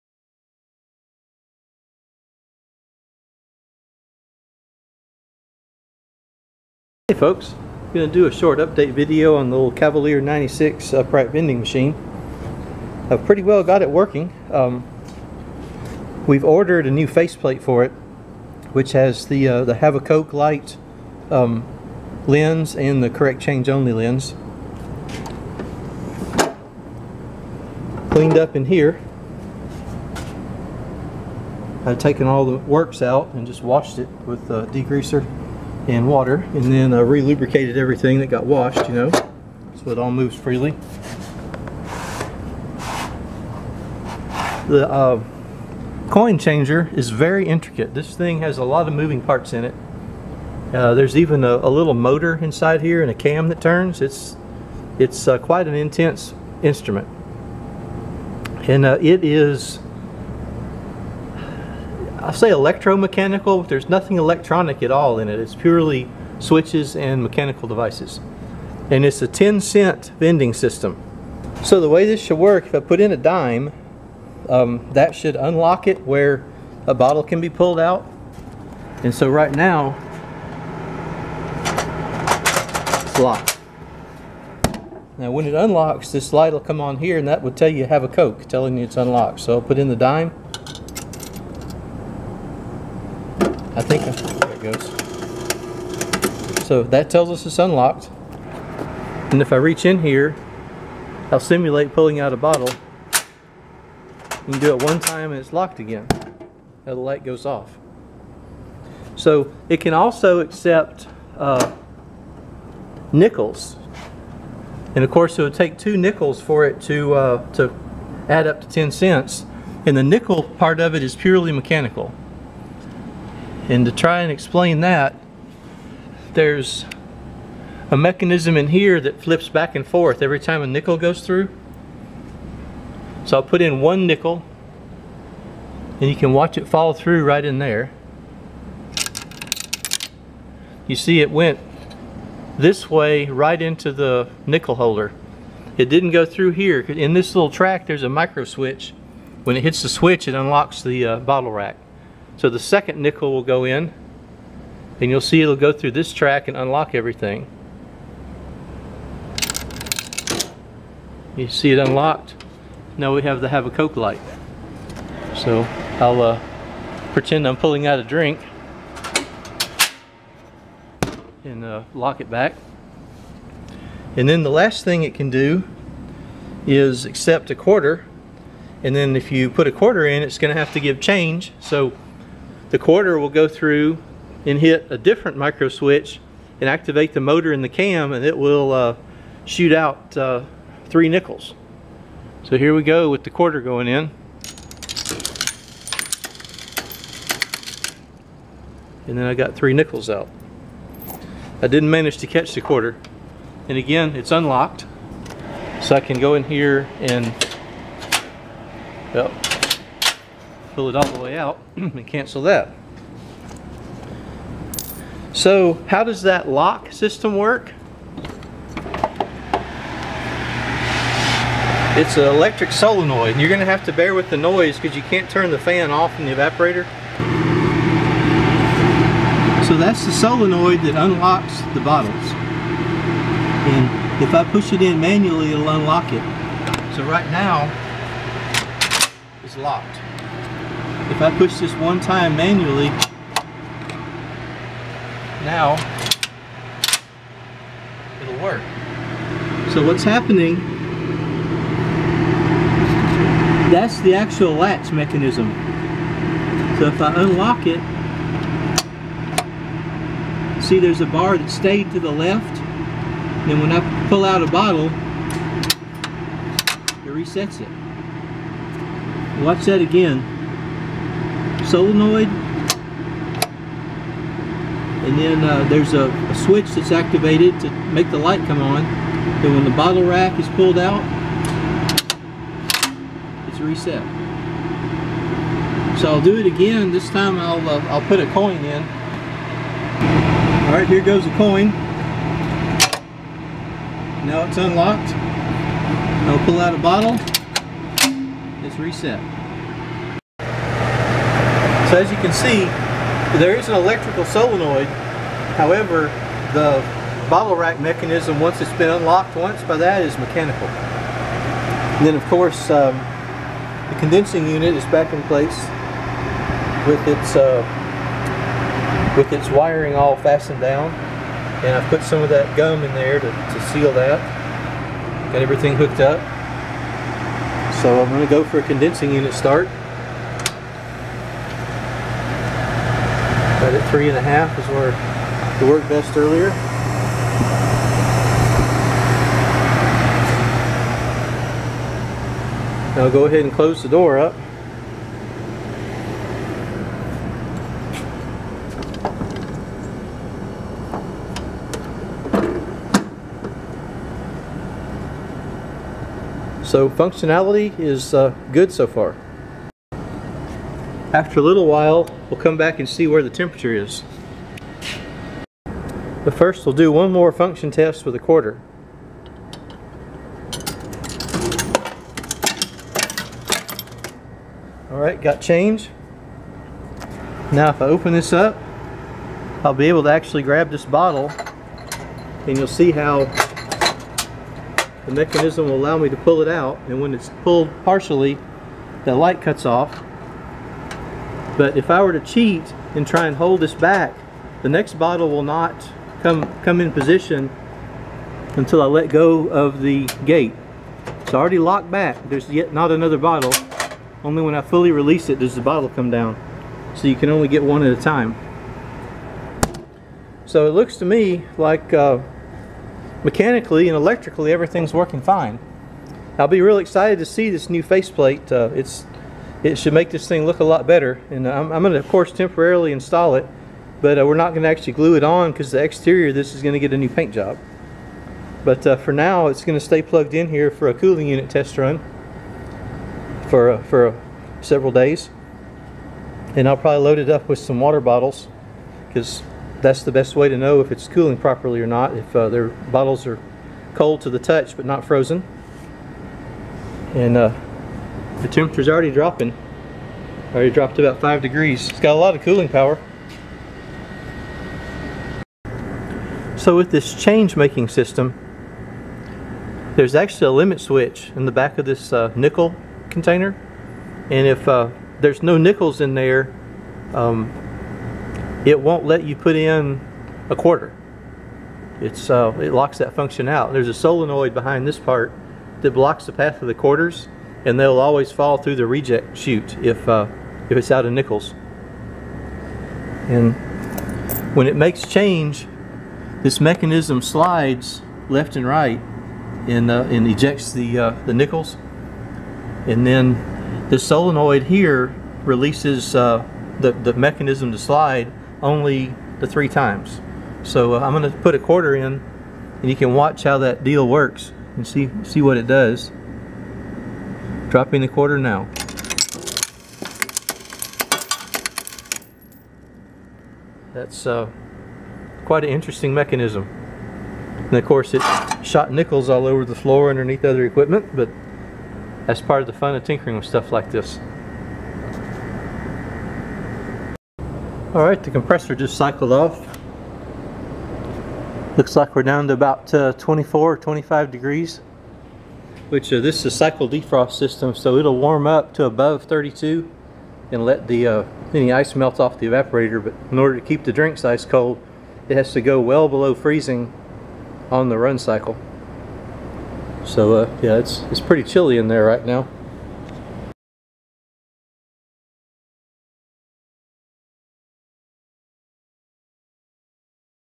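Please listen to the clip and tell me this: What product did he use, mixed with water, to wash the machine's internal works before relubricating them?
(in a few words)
degreaser.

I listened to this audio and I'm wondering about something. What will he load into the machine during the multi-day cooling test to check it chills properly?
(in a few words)
water bottles.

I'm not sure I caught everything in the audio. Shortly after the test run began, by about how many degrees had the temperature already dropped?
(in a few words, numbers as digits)
5 degrees.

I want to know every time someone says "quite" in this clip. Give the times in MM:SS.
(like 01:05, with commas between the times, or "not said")
00:55, 08:35.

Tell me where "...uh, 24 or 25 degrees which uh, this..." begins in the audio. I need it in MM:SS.
08:52.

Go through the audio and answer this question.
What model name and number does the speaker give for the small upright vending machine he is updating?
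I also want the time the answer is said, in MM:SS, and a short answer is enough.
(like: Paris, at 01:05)
Cavalier 96, at 00:09.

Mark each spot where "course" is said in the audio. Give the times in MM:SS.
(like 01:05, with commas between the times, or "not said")
01:55, 05:12, 07:02, 08:37.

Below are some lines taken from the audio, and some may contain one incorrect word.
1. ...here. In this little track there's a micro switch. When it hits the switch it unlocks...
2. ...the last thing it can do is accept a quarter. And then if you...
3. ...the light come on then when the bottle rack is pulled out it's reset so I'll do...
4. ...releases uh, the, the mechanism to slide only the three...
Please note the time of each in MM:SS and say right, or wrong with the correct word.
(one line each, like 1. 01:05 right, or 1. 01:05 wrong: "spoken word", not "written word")
1. 02:26 right
2. 02:54 right
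3. 04:38 right
4. 08:15 right.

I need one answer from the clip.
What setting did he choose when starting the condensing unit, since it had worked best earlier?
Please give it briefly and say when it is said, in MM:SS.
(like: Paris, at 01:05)
3.5, at 05:33.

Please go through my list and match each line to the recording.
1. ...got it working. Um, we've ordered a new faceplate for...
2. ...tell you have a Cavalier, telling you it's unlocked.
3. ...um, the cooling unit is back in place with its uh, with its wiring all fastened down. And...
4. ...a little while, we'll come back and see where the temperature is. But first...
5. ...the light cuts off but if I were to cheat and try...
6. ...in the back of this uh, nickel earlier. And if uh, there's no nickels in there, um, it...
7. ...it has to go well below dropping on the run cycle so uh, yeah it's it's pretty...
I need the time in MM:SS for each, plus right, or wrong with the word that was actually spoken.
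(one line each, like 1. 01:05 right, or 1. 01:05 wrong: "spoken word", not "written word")
1. 00:13 right
2. 01:27 wrong: "Coke", not "Cavalier"
3. 05:12 wrong: "condensing", not "cooling"
4. 06:01 right
5. 06:29 right
6. 07:41 wrong: "container", not "earlier"
7. 09:05 wrong: "freezing", not "dropping".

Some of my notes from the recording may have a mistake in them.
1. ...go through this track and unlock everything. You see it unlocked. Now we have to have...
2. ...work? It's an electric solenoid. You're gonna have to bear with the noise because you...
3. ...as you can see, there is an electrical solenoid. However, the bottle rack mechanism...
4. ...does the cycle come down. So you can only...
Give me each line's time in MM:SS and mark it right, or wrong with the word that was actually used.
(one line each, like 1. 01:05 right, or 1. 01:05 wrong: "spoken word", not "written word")
1. 02:35 right
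2. 03:37 right
3. 05:01 right
4. 06:45 wrong: "bottle", not "cycle".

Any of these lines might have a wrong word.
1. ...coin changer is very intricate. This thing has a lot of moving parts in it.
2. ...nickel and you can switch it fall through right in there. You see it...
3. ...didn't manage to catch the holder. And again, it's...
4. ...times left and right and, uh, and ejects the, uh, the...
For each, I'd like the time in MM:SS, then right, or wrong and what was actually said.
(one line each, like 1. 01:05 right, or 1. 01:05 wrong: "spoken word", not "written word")
1. 00:46 right
2. 02:14 wrong: "watch", not "switch"
3. 03:21 wrong: "quarter", not "holder"
4. 08:07 wrong: "slides", not "times".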